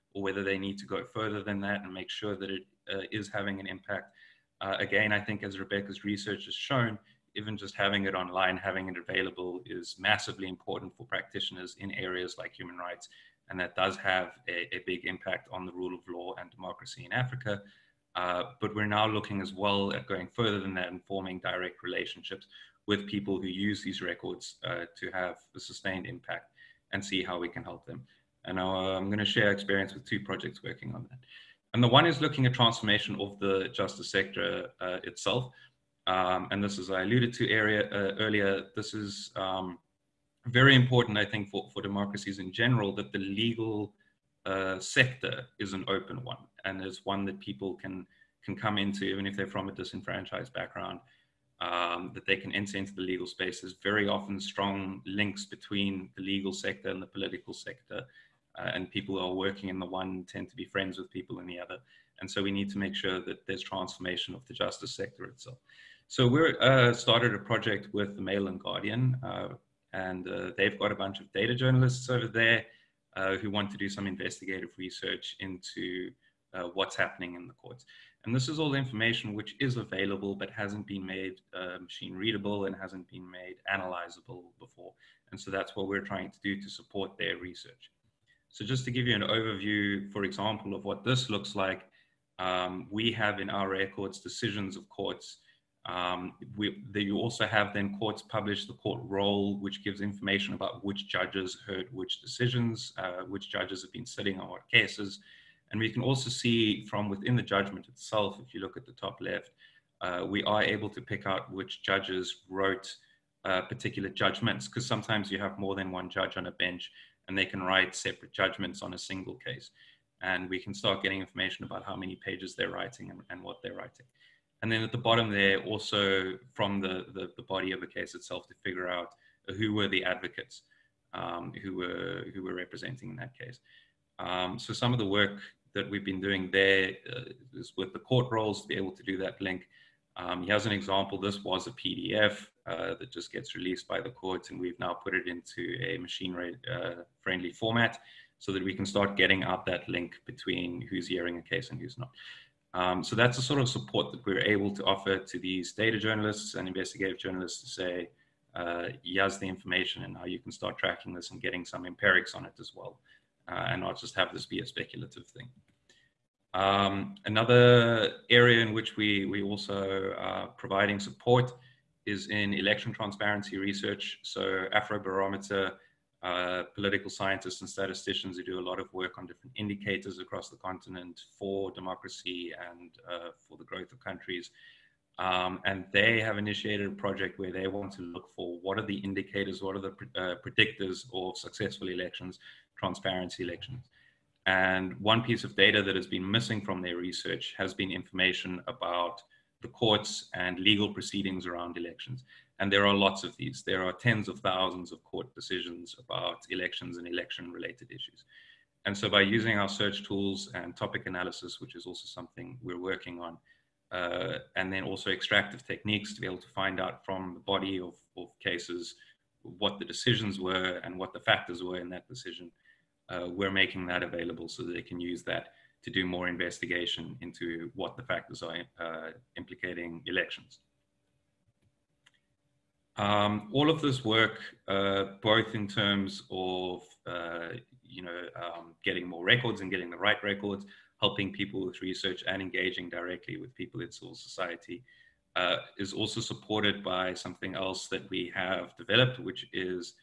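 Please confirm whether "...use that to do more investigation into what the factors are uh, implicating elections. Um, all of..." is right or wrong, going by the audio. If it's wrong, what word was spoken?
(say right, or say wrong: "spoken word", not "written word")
right.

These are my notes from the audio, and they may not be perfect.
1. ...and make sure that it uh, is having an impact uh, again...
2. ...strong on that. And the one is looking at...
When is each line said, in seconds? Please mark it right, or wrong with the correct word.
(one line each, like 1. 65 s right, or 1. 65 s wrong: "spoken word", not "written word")
1. 1 s right
2. 30 s wrong: "working", not "strong".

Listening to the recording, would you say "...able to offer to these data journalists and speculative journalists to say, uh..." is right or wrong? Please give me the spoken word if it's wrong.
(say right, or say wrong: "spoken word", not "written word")
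wrong: "investigative", not "speculative".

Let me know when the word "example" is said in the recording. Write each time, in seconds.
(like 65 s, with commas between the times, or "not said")
90 s, 140 s.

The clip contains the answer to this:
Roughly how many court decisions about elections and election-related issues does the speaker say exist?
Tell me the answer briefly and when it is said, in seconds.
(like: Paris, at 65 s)
tens of thousands, at 203 s.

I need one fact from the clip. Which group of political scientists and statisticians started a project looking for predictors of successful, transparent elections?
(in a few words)
Afrobarometer.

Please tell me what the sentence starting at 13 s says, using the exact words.
And that does have a, a big impact on the rule of law and democracy in Africa.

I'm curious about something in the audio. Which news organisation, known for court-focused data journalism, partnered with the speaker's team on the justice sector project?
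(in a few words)
Mail and Guardian.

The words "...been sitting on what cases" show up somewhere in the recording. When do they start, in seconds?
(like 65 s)
103 s.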